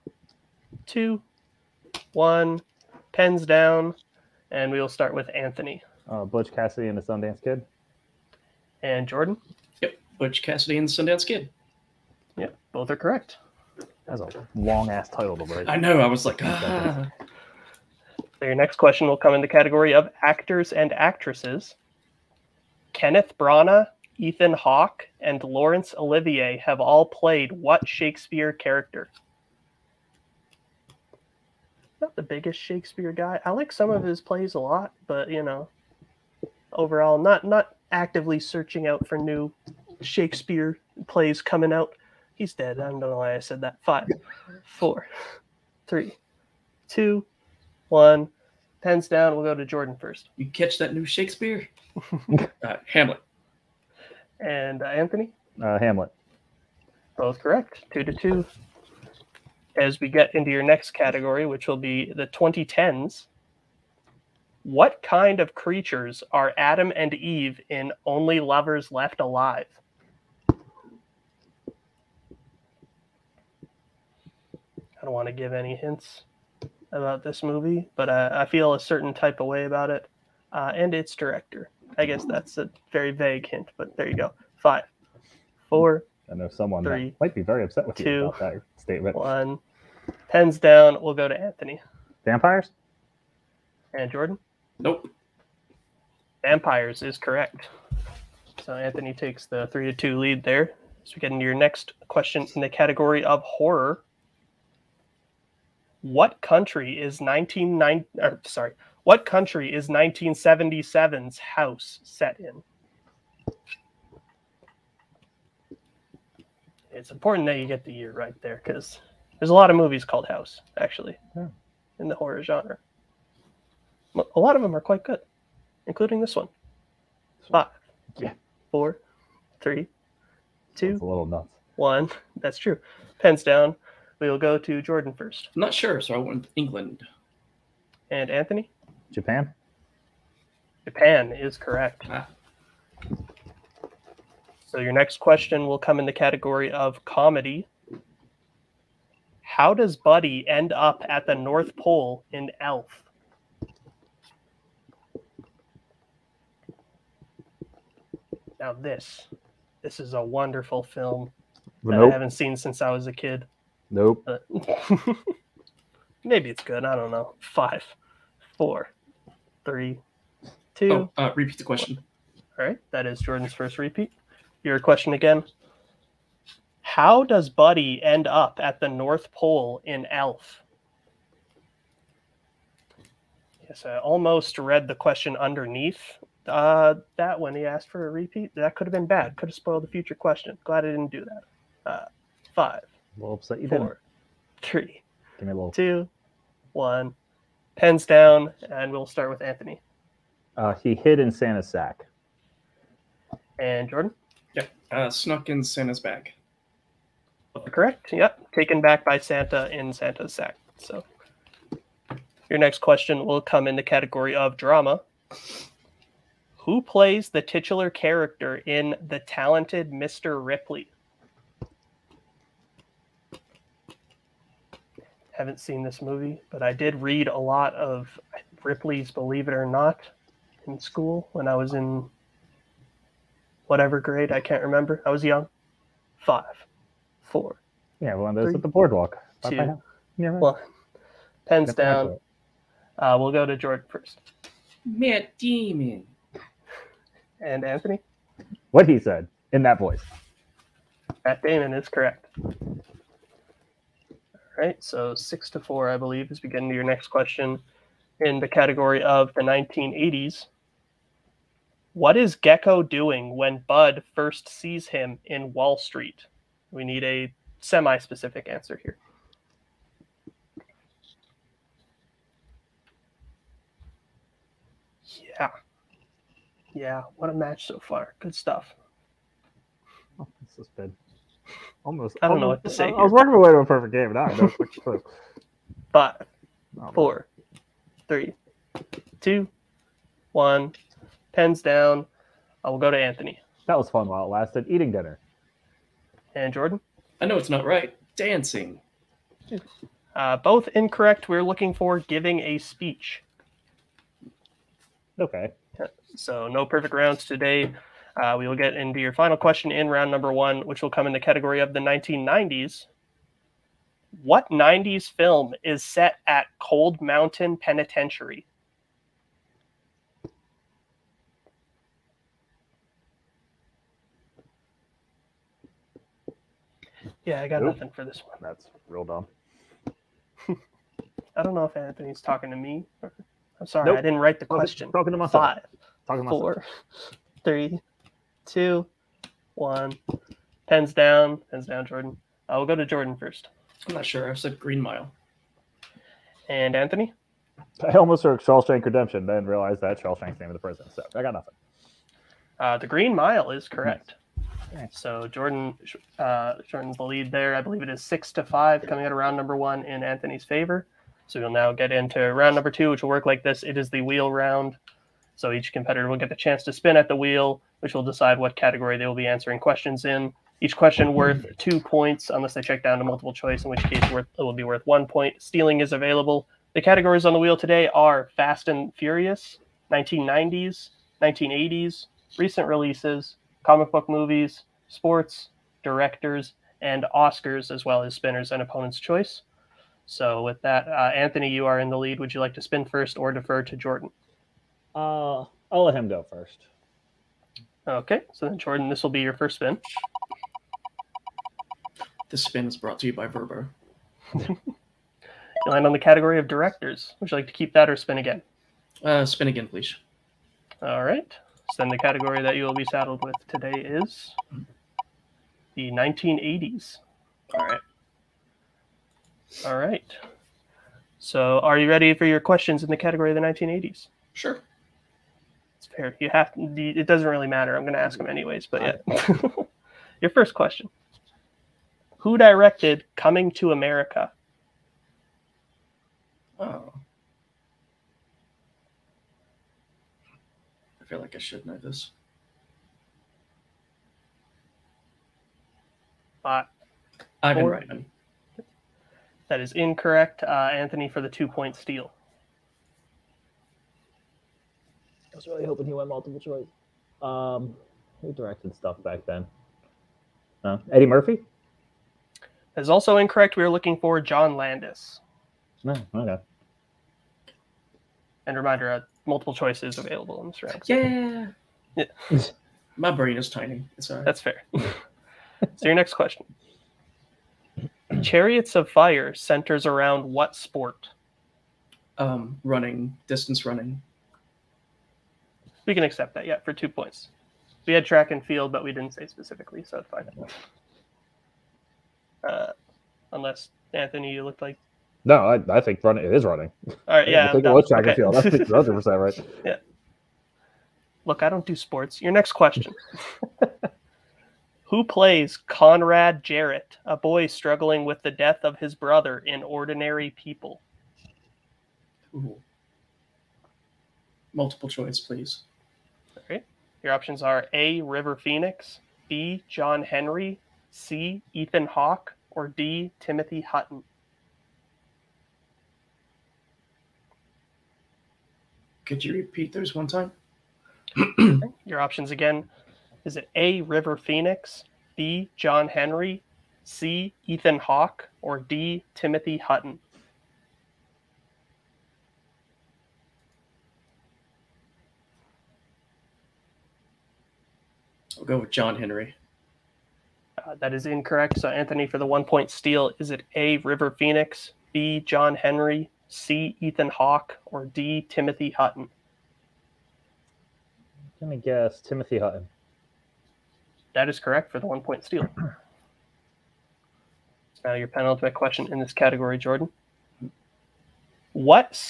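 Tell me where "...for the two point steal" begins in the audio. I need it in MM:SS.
07:31.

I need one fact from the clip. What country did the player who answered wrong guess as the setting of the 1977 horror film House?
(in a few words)
England.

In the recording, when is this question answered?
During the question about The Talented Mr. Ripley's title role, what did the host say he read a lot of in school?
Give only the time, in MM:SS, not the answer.
03:48.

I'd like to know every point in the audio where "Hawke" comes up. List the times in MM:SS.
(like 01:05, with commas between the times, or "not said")
00:24, 08:41, 08:57, 09:17.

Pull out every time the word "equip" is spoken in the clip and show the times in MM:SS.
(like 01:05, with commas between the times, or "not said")
not said.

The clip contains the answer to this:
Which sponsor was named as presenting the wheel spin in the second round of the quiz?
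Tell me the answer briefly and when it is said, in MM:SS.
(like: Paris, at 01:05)
Verbo, at 06:42.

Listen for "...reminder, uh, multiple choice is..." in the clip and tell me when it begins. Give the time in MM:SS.
07:48.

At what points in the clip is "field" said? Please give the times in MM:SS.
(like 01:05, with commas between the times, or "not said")
08:08, 08:18.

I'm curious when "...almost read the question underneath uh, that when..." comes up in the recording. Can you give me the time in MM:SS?
03:03.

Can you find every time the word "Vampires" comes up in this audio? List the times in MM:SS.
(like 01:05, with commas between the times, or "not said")
01:32, 01:36.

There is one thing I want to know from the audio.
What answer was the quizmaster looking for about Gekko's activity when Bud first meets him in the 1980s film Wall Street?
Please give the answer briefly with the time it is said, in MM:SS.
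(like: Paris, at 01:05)
Giving a speech, at 05:01.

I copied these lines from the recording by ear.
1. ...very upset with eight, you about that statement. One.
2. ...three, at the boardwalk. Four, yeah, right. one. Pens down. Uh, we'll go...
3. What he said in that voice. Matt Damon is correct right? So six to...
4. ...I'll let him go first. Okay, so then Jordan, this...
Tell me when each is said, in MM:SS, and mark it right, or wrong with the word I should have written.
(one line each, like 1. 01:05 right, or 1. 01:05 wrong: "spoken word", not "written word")
1. 01:27 wrong: "two", not "eight"
2. 03:58 wrong: "Two", not "Four"
3. 04:08 right
4. 06:35 right.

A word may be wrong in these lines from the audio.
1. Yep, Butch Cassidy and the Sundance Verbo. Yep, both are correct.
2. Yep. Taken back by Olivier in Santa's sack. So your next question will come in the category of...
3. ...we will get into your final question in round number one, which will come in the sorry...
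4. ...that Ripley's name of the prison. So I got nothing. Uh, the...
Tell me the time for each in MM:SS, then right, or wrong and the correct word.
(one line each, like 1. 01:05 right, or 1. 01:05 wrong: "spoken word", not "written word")
1. 00:09 wrong: "Kid", not "Verbo"
2. 03:28 wrong: "Santa", not "Olivier"
3. 05:08 wrong: "category", not "sorry"
4. 05:49 wrong: "Shawshank", not "Ripley".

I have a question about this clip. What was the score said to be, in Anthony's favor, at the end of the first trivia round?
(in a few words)
6 to 5.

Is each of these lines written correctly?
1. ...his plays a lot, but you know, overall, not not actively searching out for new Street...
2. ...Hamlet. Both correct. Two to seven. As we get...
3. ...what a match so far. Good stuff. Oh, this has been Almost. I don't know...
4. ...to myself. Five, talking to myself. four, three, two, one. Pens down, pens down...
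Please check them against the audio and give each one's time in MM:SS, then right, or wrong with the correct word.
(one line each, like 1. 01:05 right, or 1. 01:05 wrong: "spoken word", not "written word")
1. 00:34 wrong: "Shakespeare", not "Street"
2. 00:55 wrong: "two", not "seven"
3. 04:37 right
4. 05:35 right.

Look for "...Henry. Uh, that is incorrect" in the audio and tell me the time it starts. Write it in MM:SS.
09:08.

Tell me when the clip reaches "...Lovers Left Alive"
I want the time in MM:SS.
01:08.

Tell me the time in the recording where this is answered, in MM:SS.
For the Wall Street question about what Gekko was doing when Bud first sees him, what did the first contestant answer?
04:54.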